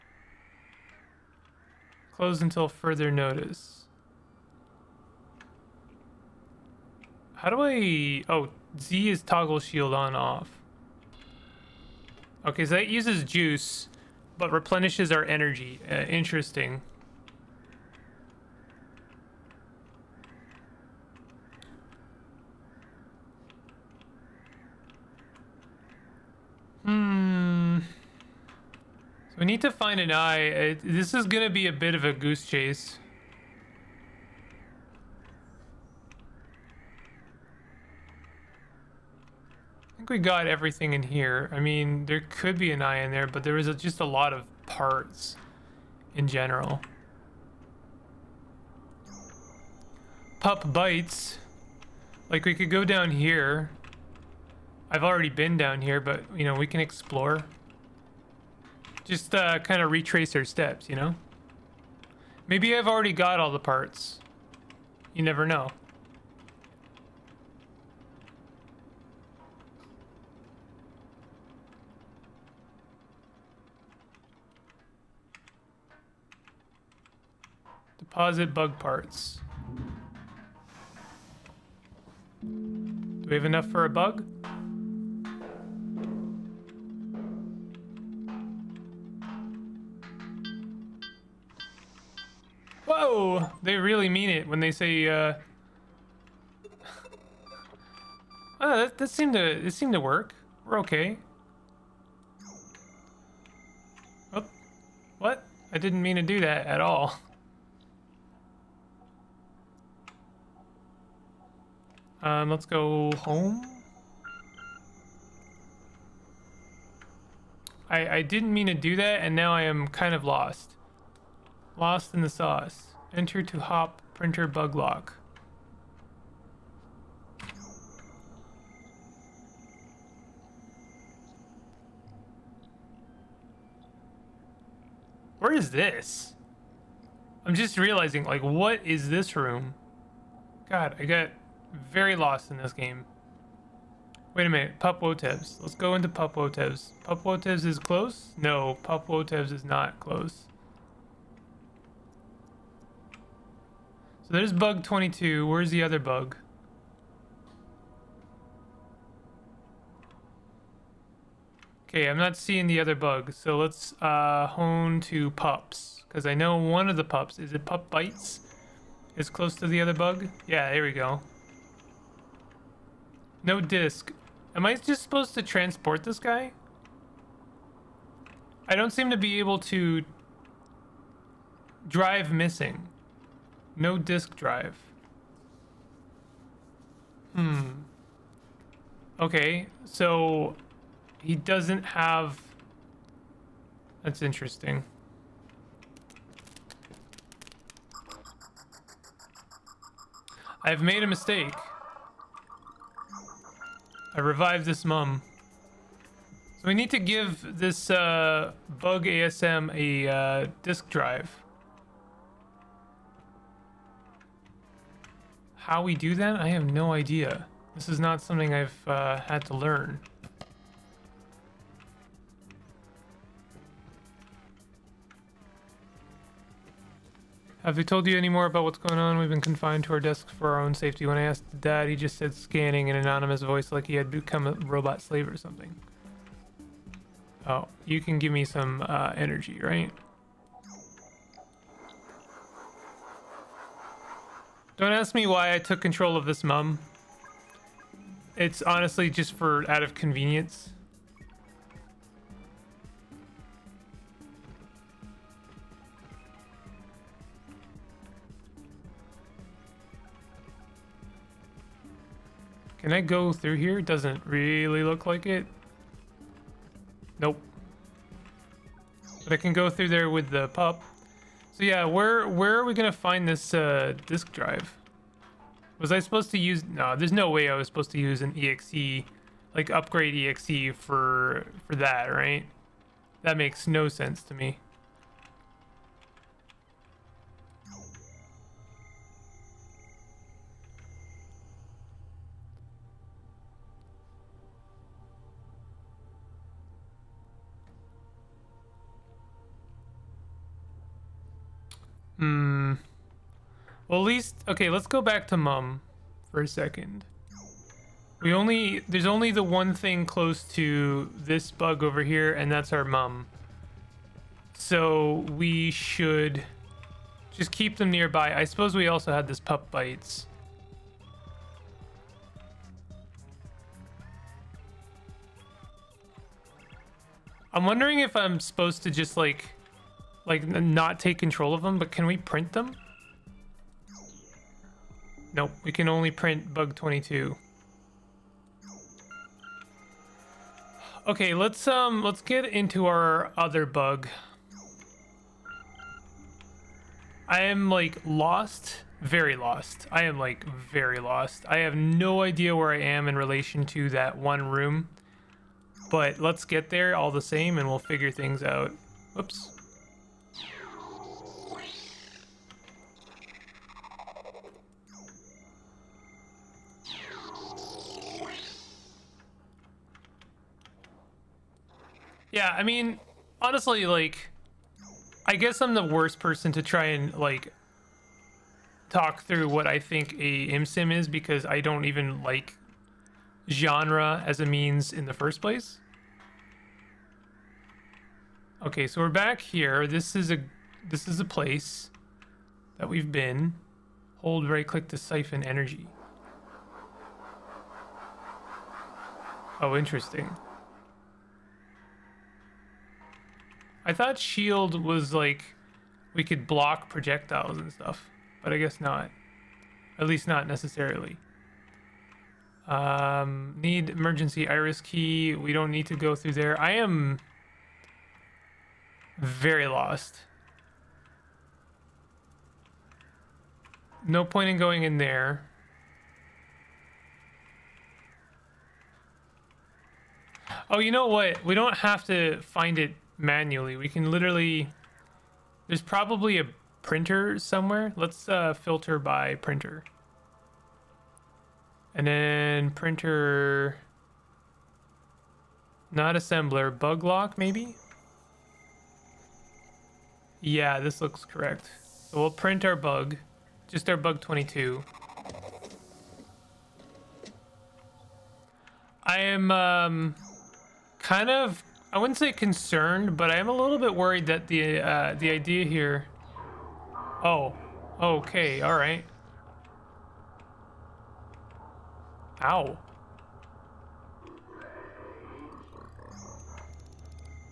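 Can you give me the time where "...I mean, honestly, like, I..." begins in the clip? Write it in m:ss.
6:12.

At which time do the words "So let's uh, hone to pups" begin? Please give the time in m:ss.
2:43.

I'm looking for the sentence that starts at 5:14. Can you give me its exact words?
So we should just keep them nearby.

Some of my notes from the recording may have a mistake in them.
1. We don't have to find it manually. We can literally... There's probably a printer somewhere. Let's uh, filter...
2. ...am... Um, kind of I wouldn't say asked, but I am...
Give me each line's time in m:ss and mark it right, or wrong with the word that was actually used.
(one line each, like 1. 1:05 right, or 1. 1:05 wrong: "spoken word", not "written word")
1. 7:11 right
2. 7:39 wrong: "concerned", not "asked".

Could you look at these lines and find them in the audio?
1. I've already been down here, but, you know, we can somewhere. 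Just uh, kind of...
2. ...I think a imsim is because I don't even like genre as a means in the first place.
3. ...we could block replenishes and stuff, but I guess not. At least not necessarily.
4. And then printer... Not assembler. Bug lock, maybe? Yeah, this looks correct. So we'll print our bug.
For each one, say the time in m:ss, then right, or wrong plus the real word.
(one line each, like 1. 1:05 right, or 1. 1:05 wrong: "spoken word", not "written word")
1. 0:54 wrong: "explore", not "somewhere"
2. 6:19 right
3. 6:46 wrong: "projectiles", not "replenishes"
4. 7:21 right.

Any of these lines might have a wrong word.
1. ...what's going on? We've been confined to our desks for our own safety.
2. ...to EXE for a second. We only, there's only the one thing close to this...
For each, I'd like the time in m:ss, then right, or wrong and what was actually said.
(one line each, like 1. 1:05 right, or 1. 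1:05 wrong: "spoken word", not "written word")
1. 3:48 right
2. 5:05 wrong: "Mum", not "EXE".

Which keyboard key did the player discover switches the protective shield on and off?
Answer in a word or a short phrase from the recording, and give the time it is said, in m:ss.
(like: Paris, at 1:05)
Z, at 0:08.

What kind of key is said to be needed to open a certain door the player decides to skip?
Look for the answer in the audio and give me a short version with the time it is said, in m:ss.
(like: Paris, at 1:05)
emergency iris key, at 6:53.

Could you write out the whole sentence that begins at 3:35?
How we do that, I have no idea.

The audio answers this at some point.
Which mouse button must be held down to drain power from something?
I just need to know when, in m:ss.
6:34.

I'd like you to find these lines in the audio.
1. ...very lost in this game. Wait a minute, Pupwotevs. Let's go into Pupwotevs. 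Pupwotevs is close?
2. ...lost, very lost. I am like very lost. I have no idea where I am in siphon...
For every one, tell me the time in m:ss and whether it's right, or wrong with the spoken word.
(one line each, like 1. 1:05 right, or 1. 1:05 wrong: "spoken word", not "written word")
1. 2:21 right
2. 5:48 wrong: "relation", not "siphon".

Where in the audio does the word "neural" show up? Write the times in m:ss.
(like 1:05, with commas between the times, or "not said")
not said.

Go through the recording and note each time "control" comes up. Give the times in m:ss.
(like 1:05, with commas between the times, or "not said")
4:05, 5:31.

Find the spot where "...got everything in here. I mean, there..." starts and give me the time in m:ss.
0:40.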